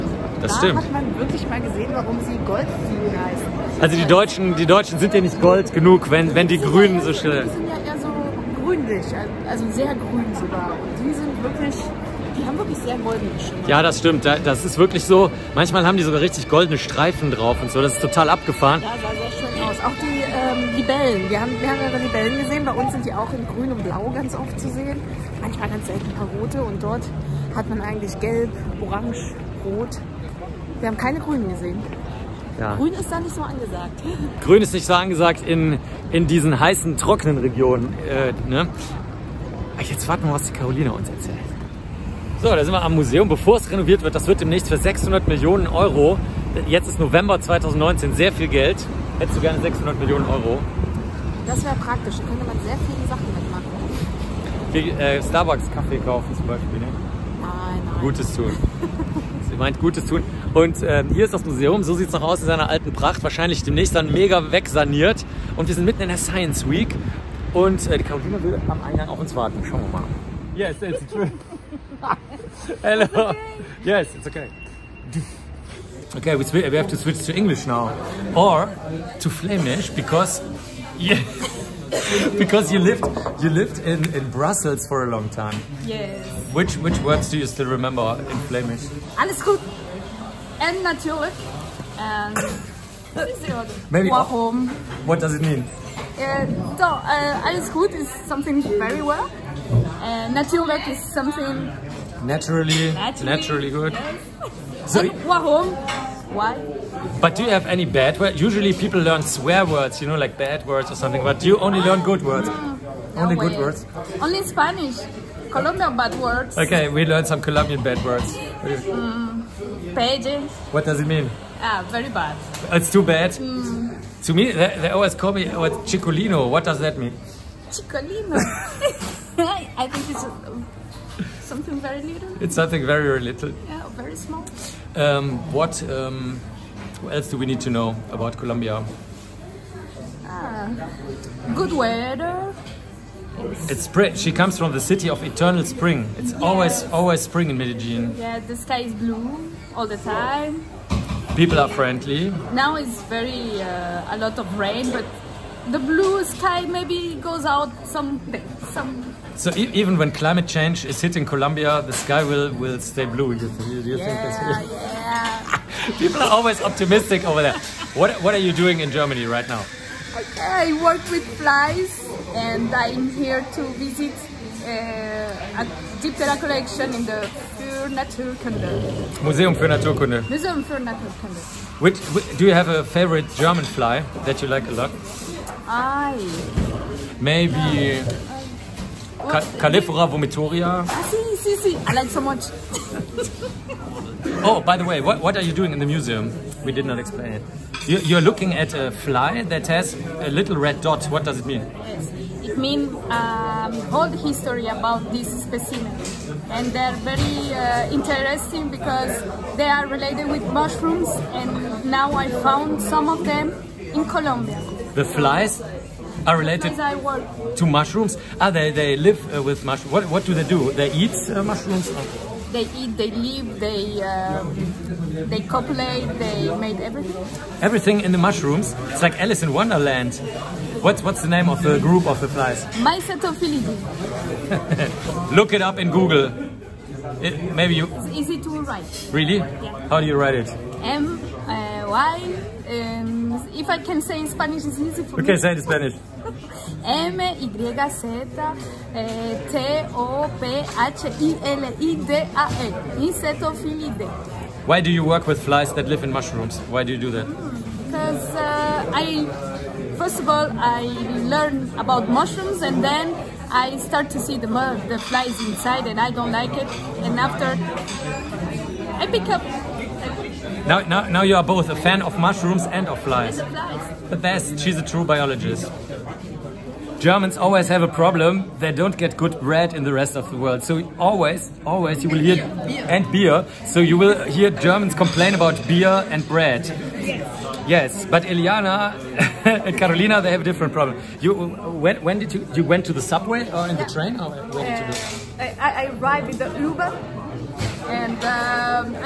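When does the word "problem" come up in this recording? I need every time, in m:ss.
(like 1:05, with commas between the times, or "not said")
4:37, 4:50.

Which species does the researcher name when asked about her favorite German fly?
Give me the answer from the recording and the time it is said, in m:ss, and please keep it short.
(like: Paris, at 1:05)
Calliphora vomitoria, at 3:09.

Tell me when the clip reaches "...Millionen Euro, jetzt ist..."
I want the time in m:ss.
0:45.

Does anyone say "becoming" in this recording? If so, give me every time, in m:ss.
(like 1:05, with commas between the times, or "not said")
not said.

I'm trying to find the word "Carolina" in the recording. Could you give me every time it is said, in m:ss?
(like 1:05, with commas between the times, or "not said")
0:40, 1:08, 4:49.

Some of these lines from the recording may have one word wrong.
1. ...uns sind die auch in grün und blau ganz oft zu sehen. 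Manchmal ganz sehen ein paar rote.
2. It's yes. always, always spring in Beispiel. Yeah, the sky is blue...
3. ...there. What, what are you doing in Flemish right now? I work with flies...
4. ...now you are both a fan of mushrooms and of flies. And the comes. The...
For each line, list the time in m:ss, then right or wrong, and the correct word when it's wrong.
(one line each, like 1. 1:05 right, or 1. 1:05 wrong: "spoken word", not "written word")
1. 0:22 wrong: "selten", not "sehen"
2. 2:26 wrong: "Medellin", not "Beispiel"
3. 2:47 wrong: "Germany", not "Flemish"
4. 4:31 wrong: "flies", not "comes".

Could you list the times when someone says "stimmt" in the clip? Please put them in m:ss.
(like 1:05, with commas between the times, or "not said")
0:00, 0:13.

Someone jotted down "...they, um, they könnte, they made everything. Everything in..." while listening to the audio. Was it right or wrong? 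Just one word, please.
wrong.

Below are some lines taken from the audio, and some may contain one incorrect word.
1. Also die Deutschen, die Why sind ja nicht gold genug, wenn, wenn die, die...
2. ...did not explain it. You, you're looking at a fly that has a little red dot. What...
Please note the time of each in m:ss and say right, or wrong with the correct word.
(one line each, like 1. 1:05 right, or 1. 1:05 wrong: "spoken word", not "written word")
1. 0:03 wrong: "Deutschen", not "Why"
2. 3:16 right.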